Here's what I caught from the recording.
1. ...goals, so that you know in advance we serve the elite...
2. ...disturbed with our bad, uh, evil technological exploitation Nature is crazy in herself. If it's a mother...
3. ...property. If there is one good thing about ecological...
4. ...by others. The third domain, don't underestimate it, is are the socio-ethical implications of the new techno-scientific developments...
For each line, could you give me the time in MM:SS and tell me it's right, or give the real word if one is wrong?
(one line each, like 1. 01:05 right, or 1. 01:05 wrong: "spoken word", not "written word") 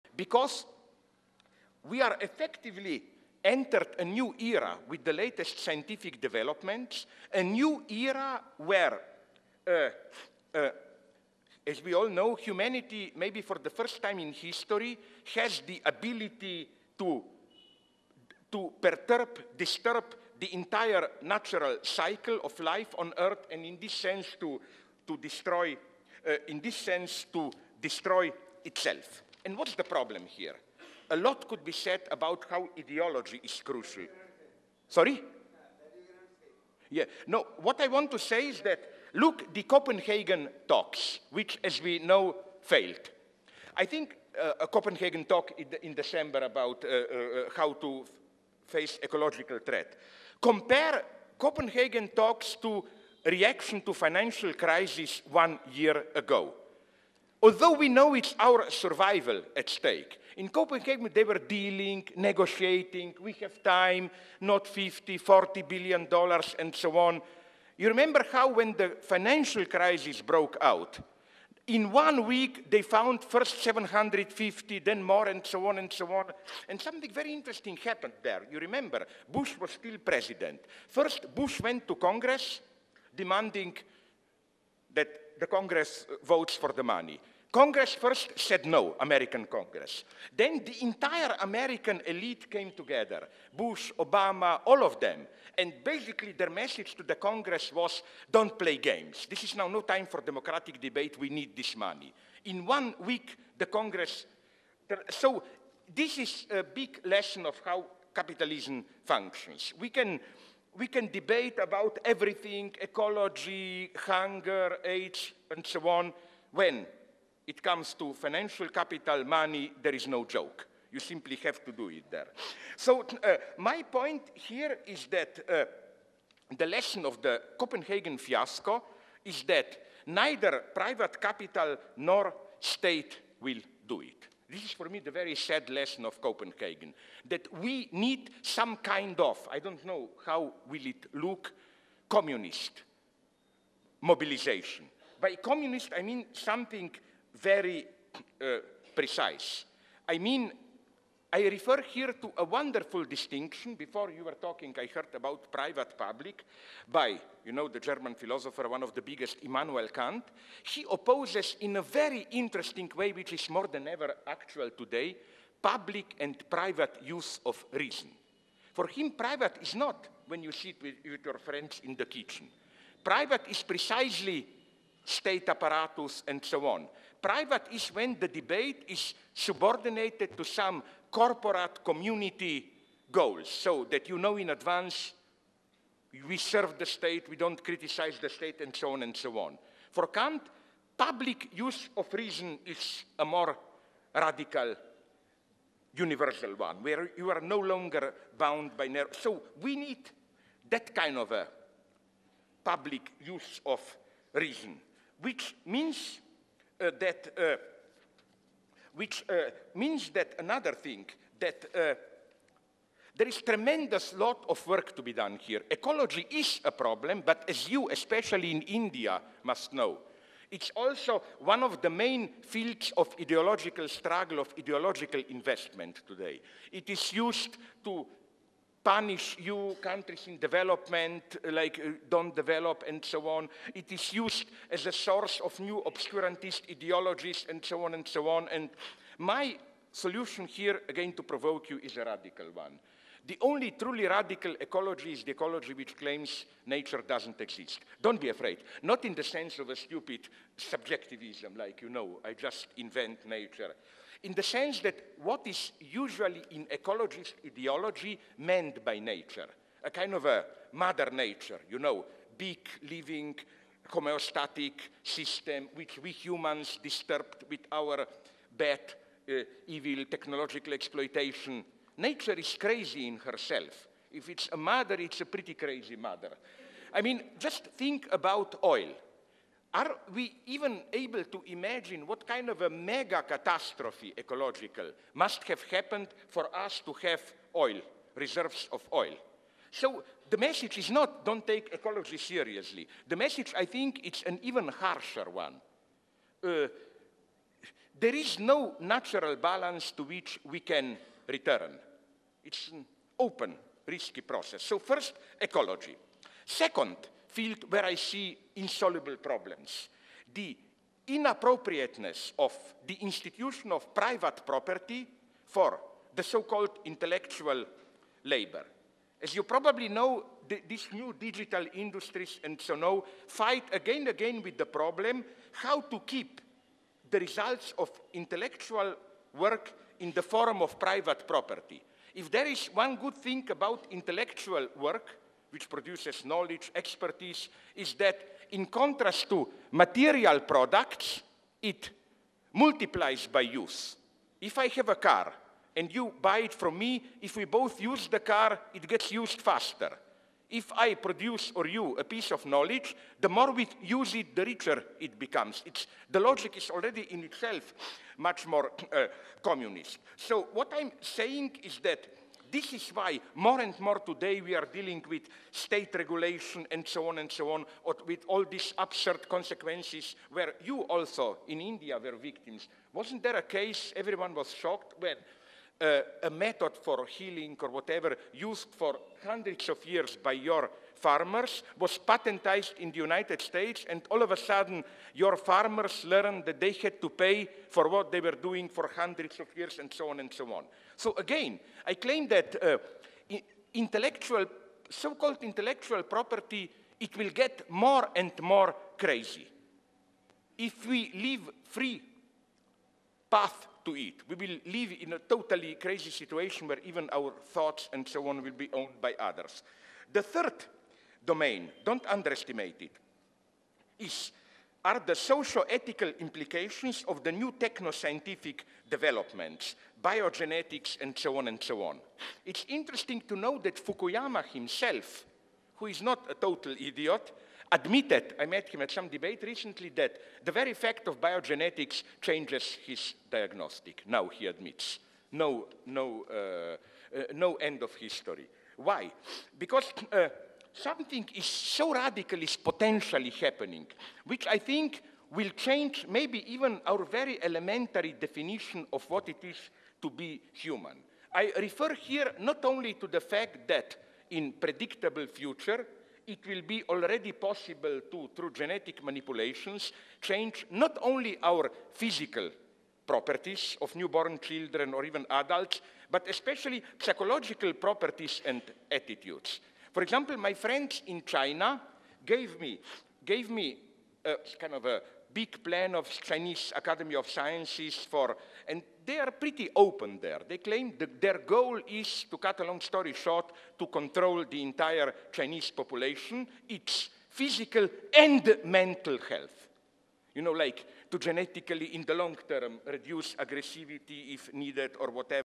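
1. 03:03 wrong: "state", not "elite"
2. 04:26 right
3. 05:31 wrong: "intellectual", not "ecological"
4. 06:49 right.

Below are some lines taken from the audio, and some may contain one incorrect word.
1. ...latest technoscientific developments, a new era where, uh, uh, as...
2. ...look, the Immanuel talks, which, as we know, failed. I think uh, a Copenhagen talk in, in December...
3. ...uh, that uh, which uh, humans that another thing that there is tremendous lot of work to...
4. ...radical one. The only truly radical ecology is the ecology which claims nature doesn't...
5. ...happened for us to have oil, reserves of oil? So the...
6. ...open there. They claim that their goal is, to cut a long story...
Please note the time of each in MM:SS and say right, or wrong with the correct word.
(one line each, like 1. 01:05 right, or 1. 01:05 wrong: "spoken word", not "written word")
1. 00:05 wrong: "scientific", not "technoscientific"
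2. 00:39 wrong: "Copenhagen", not "Immanuel"
3. 03:26 wrong: "means", not "humans"
4. 04:02 right
5. 04:45 right
6. 07:59 right.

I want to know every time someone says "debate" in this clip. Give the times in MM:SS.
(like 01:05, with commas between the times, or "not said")
01:40, 01:51, 02:58, 07:09.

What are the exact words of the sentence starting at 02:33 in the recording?
Before you were talking, I heard about private-public by, you know, the German philosopher, one of the biggest, Immanuel Kant.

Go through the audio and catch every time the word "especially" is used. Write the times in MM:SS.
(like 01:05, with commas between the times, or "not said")
03:37, 07:46.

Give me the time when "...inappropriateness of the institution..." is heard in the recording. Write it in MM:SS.
05:11.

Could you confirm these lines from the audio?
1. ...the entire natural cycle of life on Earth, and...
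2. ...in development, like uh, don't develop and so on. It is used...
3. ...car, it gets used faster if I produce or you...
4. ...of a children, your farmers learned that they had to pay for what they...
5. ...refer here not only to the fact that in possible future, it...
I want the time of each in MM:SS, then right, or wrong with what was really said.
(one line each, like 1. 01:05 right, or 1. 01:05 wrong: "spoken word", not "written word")
1. 00:20 right
2. 03:50 right
3. 05:48 right
4. 06:24 wrong: "sudden", not "children"
5. 07:31 wrong: "predictable", not "possible".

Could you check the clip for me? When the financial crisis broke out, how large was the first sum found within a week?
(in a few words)
750.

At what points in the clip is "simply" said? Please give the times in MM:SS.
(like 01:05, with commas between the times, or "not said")
02:00.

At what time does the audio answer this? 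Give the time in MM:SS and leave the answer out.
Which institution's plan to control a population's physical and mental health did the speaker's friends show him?
07:56.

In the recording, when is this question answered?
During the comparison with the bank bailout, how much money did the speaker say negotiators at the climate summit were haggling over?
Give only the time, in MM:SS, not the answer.
01:05.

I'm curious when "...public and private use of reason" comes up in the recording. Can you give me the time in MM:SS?
02:45.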